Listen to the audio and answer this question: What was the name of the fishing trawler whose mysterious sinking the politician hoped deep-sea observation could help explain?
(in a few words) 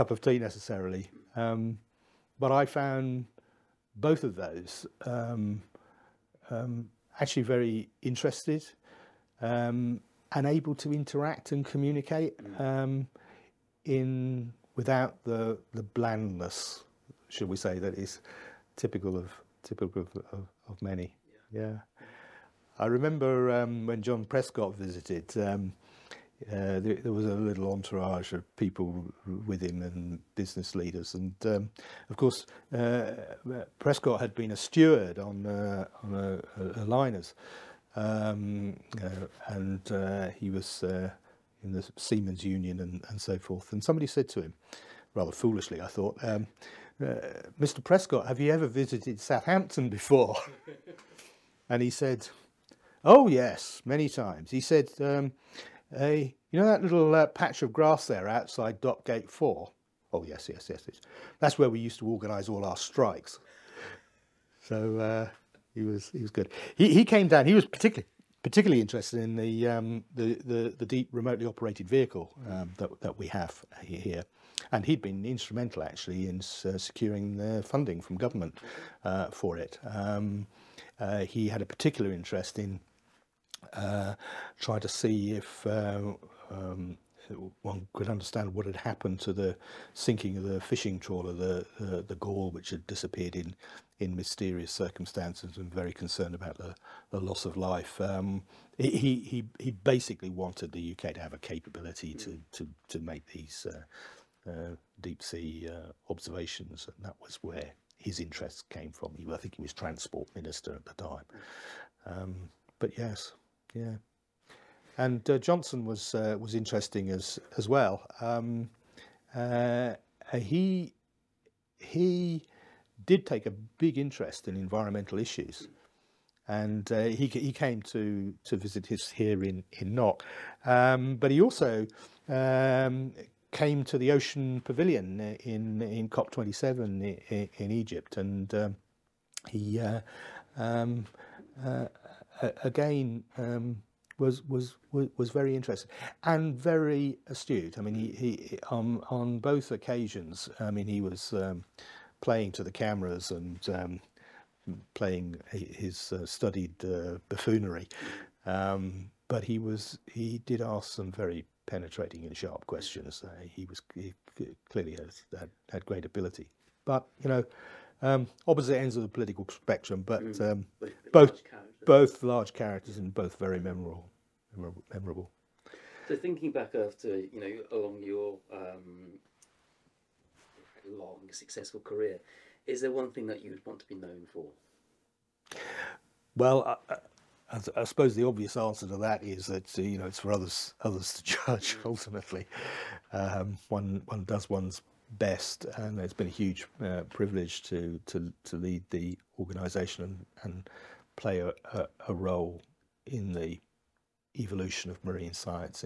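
The Gaul.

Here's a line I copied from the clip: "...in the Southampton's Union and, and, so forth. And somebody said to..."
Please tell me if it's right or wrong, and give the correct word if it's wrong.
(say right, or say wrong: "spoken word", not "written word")
wrong: "Seamen", not "Southampton".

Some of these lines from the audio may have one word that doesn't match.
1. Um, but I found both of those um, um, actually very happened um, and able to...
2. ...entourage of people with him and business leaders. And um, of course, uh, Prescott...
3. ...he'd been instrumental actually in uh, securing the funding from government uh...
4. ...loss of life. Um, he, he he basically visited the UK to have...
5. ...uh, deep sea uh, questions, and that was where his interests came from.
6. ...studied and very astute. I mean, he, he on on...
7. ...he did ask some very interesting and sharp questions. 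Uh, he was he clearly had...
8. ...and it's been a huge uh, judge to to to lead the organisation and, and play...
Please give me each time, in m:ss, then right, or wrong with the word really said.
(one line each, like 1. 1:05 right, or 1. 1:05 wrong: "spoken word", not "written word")
1. 0:01 wrong: "interested", not "happened"
2. 0:27 right
3. 1:14 right
4. 1:37 wrong: "wanted", not "visited"
5. 1:44 wrong: "observations", not "questions"
6. 2:25 wrong: "interested", not "studied"
7. 2:40 wrong: "penetrating", not "interesting"
8. 3:15 wrong: "privilege", not "judge".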